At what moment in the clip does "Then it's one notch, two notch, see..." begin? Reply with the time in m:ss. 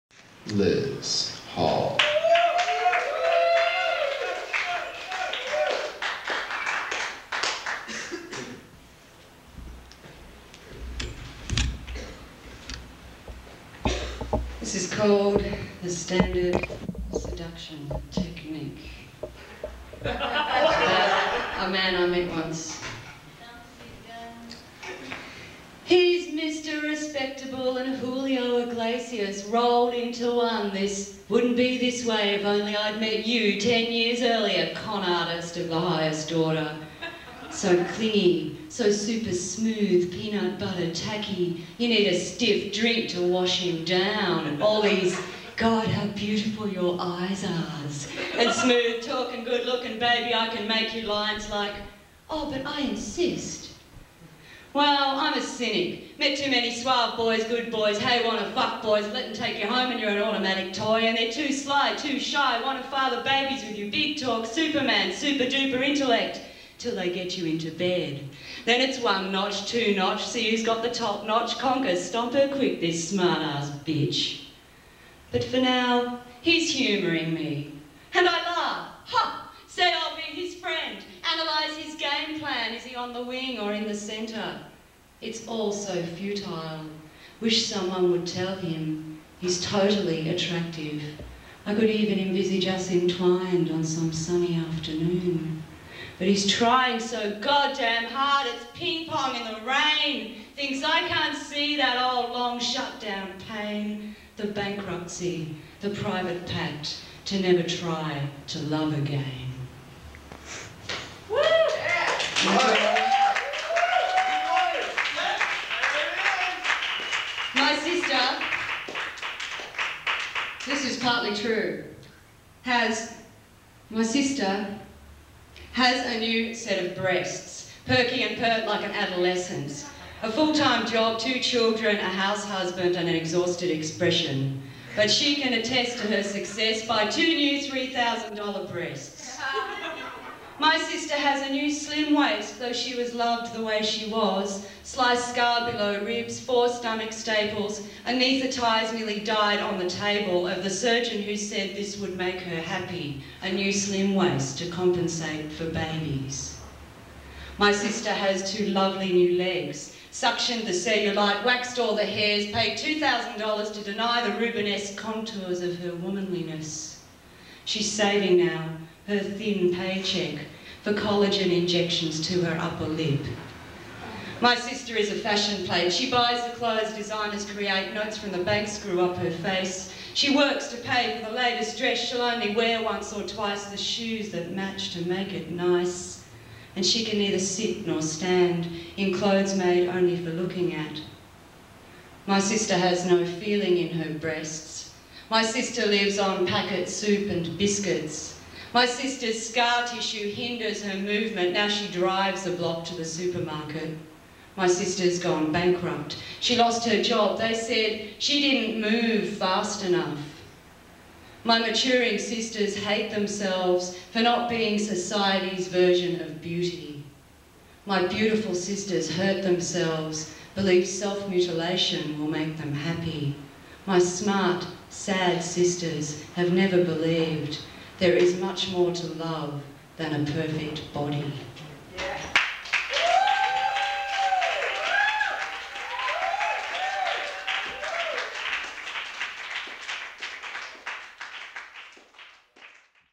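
1:08.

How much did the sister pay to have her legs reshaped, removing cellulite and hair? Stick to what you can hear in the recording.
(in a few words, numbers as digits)
$2,000.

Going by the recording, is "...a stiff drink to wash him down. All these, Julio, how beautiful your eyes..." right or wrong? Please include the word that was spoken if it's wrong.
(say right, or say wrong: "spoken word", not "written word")
wrong: "God", not "Julio".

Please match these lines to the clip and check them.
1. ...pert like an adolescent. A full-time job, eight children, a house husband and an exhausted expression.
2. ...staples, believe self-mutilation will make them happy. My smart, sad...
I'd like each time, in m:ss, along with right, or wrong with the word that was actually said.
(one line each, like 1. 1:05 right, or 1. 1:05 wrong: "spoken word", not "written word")
1. 2:08 wrong: "two", not "eight"
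2. 3:39 wrong: "themselves", not "staples".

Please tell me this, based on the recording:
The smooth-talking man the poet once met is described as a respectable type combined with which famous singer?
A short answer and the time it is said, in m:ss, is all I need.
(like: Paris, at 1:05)
Julio Iglesias, at 0:27.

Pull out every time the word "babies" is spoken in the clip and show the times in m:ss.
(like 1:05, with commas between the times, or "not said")
1:03, 2:35.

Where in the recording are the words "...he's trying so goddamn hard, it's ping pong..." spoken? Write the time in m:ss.
1:36.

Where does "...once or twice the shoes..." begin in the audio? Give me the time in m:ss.
3:02.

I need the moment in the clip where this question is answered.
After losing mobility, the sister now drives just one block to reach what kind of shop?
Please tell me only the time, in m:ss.
3:23.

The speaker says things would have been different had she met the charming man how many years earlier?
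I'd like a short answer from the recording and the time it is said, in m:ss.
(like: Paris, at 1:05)
10, at 0:33.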